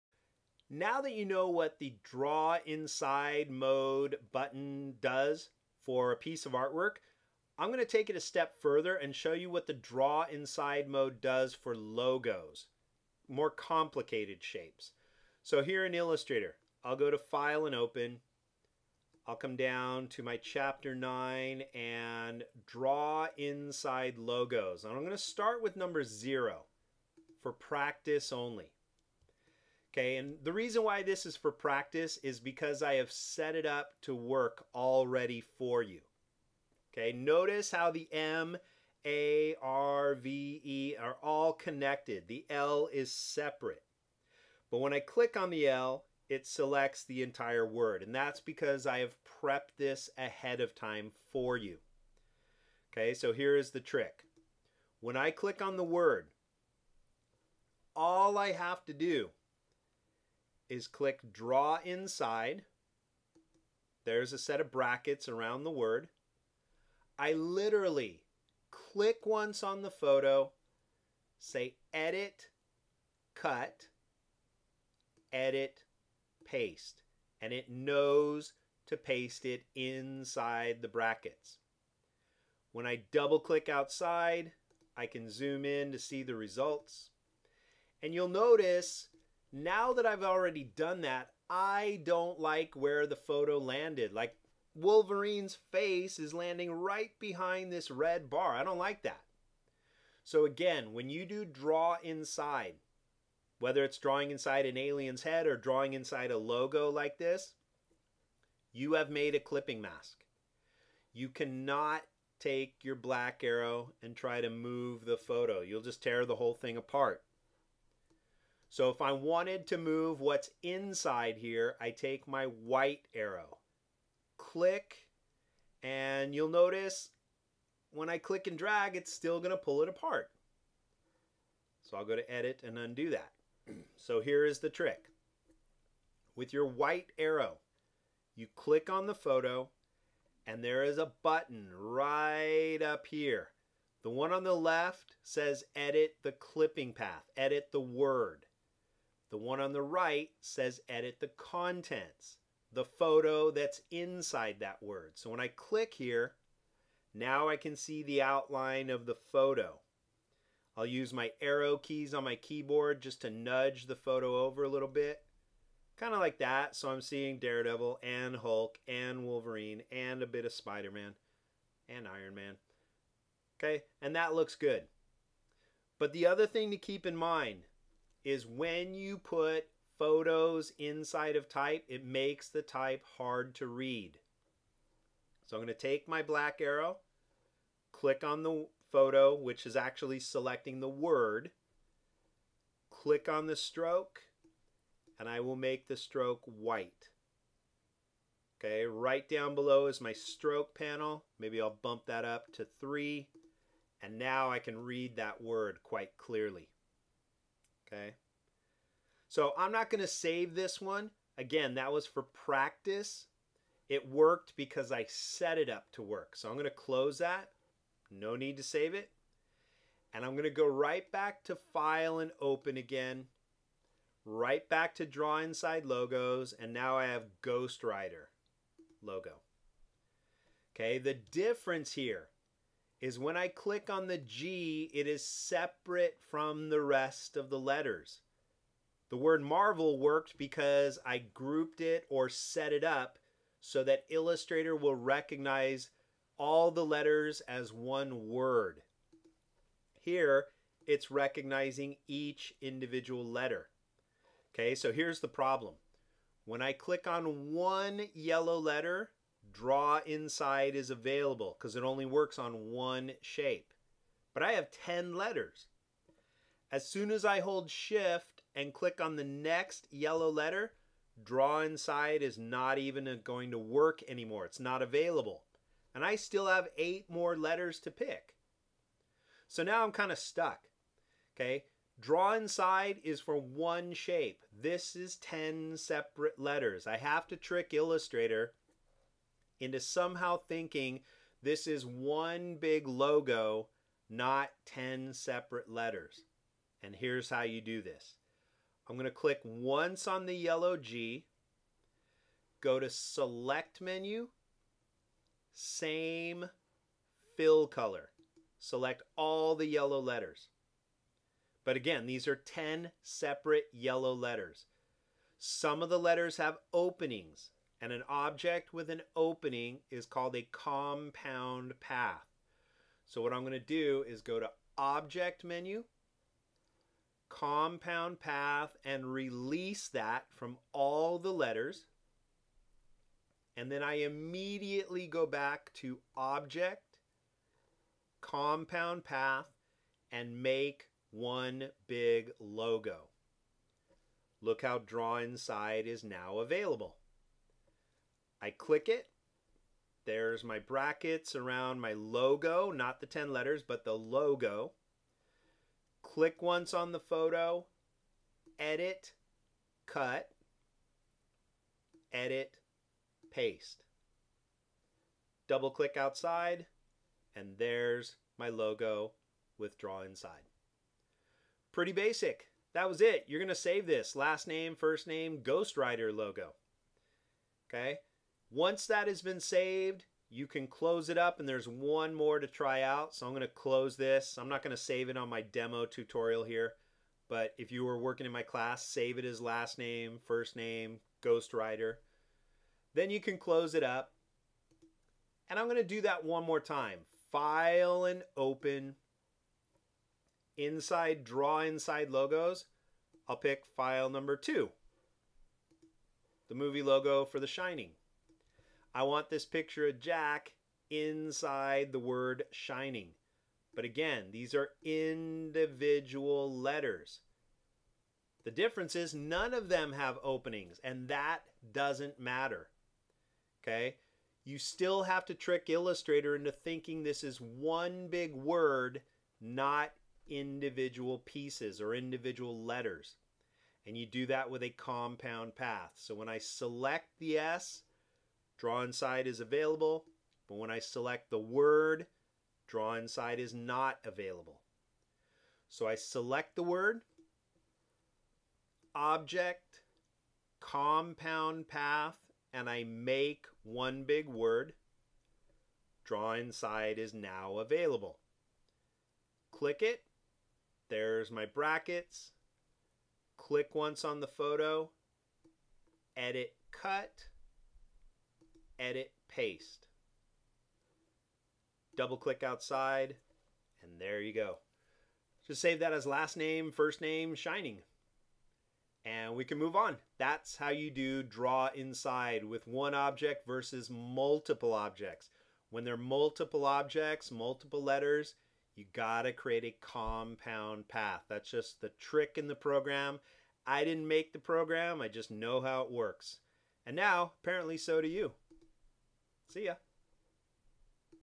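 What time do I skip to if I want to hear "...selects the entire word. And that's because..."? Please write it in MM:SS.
00:46.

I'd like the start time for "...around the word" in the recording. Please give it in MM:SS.
01:05.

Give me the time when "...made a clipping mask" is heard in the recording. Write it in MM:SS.
01:49.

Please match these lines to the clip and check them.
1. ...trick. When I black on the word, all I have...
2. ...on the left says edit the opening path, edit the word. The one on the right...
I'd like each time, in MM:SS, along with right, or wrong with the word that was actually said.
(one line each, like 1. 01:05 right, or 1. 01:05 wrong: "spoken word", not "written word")
1. 00:53 wrong: "click", not "black"
2. 02:24 wrong: "clipping", not "opening".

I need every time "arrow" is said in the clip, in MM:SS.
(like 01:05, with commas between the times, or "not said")
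01:53, 02:03, 02:17, 02:41, 03:06.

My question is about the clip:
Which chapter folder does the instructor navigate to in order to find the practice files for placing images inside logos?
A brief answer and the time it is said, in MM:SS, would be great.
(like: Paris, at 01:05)
Chapter 9, at 00:20.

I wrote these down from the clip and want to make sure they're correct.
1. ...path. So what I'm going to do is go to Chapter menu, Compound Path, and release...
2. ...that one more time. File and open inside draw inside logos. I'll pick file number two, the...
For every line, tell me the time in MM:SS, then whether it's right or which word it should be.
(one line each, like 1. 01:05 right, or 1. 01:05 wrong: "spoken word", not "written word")
1. 05:21 wrong: "Object", not "Chapter"
2. 06:36 right.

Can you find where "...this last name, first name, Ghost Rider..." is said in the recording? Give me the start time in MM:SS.
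06:13.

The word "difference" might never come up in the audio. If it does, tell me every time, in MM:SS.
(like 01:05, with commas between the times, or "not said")
03:51, 06:58.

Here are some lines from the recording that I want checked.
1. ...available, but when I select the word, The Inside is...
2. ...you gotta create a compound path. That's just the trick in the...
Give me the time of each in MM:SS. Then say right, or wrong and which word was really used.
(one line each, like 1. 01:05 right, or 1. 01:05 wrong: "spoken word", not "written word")
1. 07:19 wrong: "Draw", not "The"
2. 08:08 right.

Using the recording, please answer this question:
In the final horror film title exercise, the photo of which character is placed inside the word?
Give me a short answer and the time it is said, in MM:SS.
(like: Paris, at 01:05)
Jack, at 06:49.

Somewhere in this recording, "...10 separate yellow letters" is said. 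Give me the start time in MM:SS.
05:12.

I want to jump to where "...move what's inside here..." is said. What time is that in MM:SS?
01:59.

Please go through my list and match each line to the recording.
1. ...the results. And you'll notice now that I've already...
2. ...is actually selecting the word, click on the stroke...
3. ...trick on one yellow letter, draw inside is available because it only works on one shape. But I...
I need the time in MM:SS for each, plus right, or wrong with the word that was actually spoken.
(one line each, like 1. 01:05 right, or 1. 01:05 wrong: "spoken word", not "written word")
1. 01:26 right
2. 03:09 right
3. 04:16 wrong: "click", not "trick".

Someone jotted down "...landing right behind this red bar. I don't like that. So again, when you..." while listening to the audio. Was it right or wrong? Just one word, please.
right.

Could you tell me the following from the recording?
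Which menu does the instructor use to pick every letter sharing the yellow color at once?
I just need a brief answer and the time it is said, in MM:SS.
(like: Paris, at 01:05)
Select menu, at 05:02.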